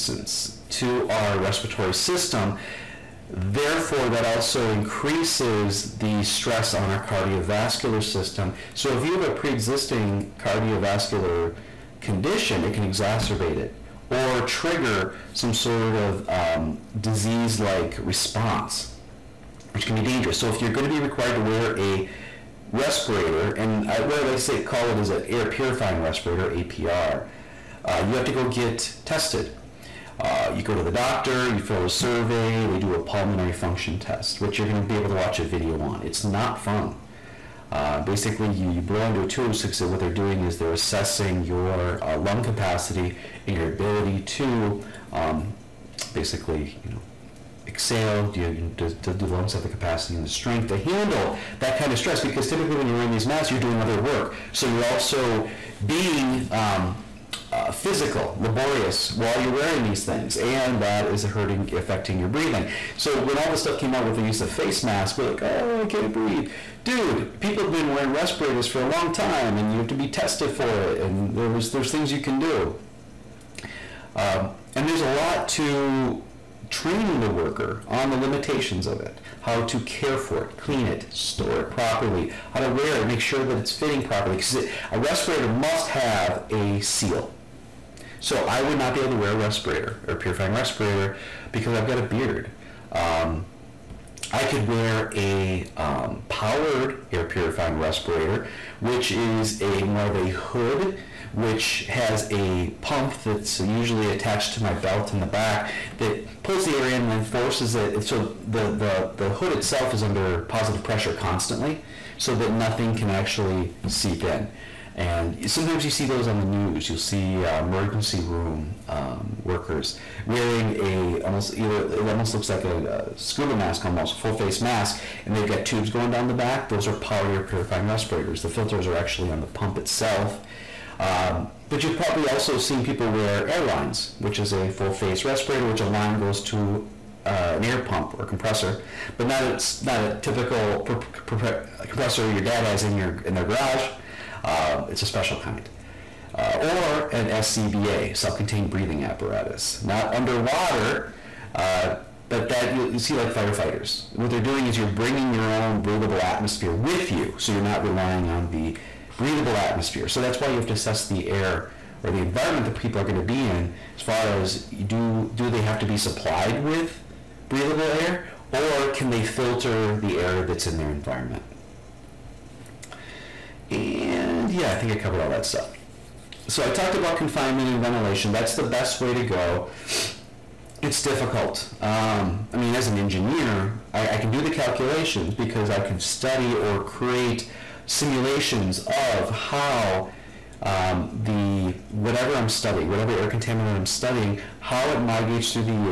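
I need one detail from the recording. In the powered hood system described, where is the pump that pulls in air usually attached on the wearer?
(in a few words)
belt in the back.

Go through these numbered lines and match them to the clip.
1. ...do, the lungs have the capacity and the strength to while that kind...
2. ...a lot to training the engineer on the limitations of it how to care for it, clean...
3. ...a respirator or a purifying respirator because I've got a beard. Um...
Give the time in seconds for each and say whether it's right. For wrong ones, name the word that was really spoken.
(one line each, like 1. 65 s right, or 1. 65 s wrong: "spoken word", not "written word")
1. 48 s wrong: "handle", not "while"
2. 74 s wrong: "worker", not "engineer"
3. 89 s right.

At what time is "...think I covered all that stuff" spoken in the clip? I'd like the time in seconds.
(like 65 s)
174 s.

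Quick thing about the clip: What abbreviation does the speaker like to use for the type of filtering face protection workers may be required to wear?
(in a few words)
APR.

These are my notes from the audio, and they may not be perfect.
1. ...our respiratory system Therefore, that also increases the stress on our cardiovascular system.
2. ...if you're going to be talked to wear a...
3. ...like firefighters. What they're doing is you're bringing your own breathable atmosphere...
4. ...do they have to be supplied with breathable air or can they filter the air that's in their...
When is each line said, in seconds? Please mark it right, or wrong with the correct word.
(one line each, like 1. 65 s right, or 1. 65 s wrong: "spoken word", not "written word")
1. 1 s right
2. 20 s wrong: "required", not "talked"
3. 153 s right
4. 165 s right.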